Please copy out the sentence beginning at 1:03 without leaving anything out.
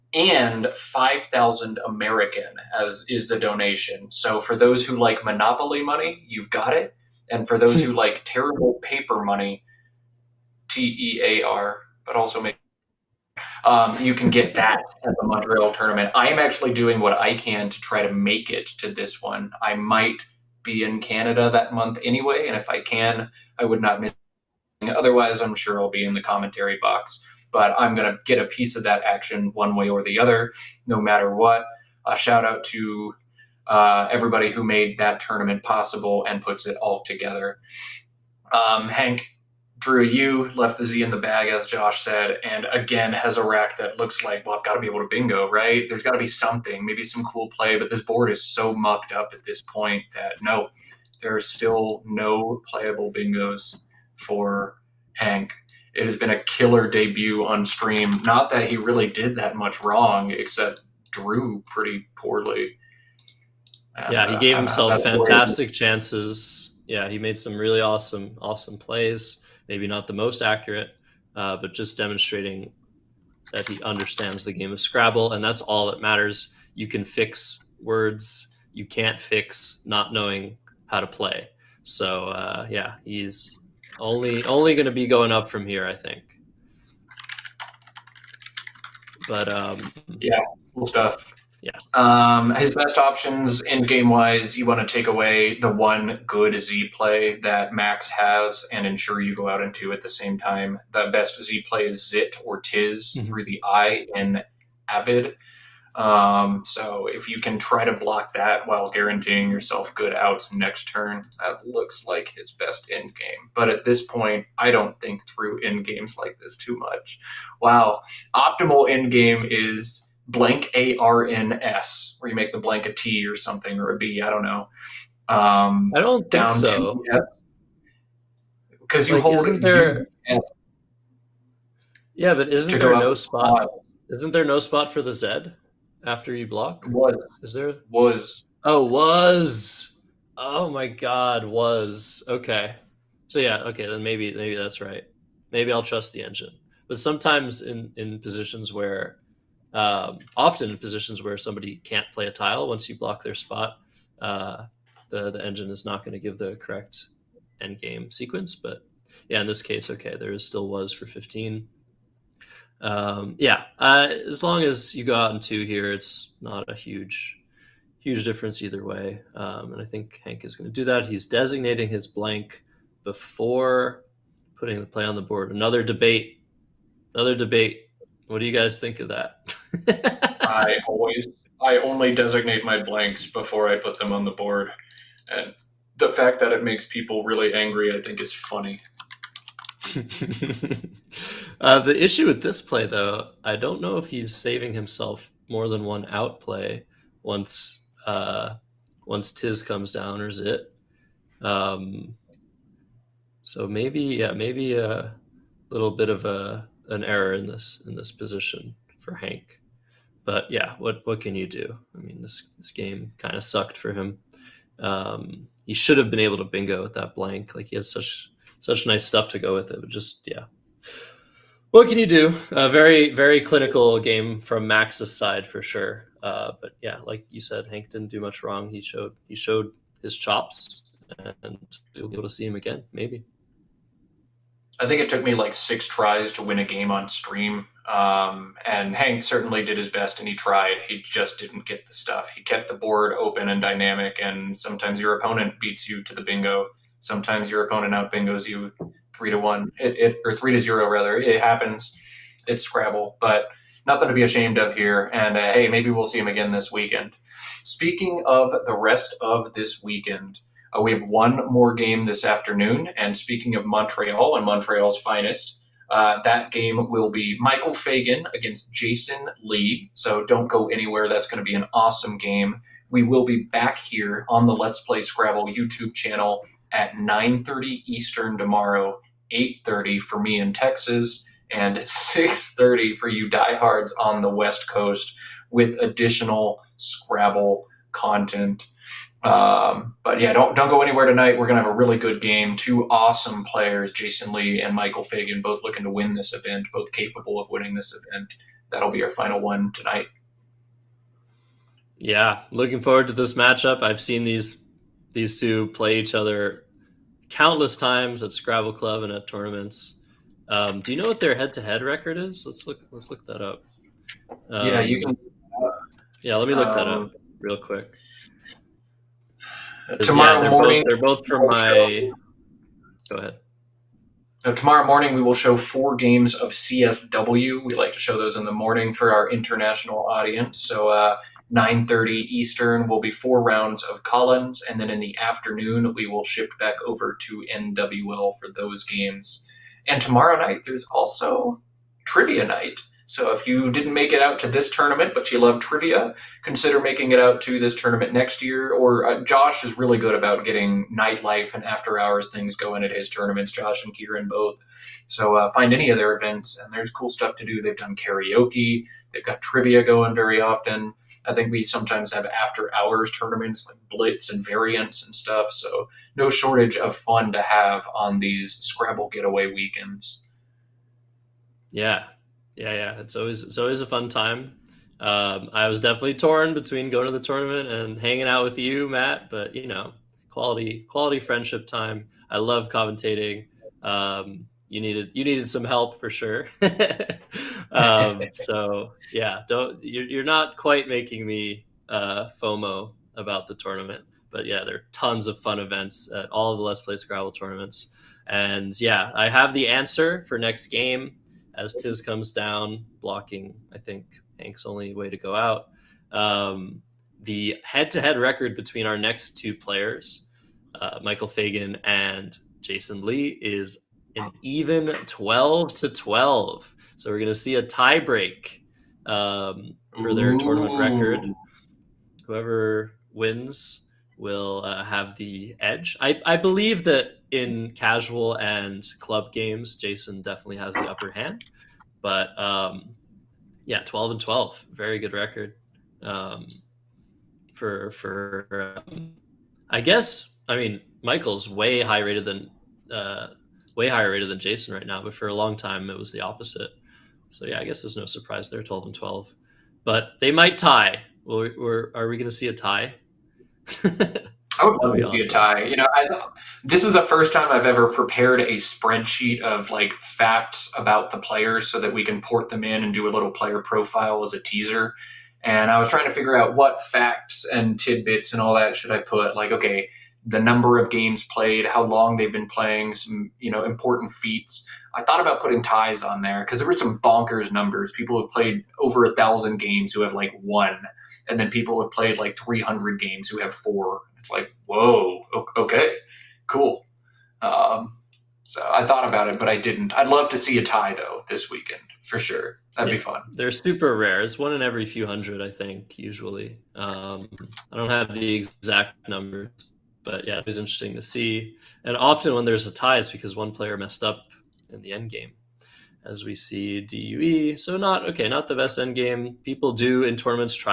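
And, yeah, he uh, gave uh, himself fantastic chances.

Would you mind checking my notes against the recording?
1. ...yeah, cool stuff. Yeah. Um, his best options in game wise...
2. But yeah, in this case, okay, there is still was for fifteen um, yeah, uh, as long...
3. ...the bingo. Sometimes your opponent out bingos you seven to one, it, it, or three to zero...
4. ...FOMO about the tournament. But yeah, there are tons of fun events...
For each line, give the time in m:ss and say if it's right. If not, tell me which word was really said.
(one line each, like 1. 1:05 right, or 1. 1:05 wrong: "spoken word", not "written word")
1. 1:30 right
2. 2:38 right
3. 4:06 wrong: "three", not "seven"
4. 6:32 right.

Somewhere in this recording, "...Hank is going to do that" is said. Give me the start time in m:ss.
2:50.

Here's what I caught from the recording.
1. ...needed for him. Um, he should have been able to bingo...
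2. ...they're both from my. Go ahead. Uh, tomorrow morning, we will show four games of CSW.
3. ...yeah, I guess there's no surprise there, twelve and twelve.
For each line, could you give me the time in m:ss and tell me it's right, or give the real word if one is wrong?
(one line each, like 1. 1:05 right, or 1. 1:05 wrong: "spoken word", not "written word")
1. 3:33 wrong: "sucked", not "needed"
2. 5:21 right
3. 7:27 right.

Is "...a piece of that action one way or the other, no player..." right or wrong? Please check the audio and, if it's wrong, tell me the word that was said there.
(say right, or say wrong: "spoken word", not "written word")
wrong: "matter", not "player".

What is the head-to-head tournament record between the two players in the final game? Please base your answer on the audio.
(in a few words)
12 to 12.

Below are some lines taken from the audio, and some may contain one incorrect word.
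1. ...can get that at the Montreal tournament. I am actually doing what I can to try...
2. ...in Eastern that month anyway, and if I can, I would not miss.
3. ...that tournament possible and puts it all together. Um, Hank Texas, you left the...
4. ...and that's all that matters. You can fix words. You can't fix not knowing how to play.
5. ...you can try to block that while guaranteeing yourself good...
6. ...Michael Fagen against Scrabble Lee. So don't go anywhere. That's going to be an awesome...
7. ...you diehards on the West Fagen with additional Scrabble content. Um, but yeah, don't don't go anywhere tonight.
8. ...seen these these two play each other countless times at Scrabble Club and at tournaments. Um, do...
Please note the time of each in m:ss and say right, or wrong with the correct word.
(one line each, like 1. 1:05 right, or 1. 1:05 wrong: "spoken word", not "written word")
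1. 0:14 right
2. 0:20 wrong: "Canada", not "Eastern"
3. 0:34 wrong: "Drew", not "Texas"
4. 1:15 right
5. 1:47 right
6. 4:27 wrong: "Jason", not "Scrabble"
7. 4:43 wrong: "Coast", not "Fagen"
8. 5:04 right.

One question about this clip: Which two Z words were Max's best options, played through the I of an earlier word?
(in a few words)
Zit or Tiz.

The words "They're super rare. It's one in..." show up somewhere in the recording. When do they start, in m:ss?
8:13.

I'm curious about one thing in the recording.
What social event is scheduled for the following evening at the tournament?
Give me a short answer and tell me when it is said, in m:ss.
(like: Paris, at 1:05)
trivia night, at 5:42.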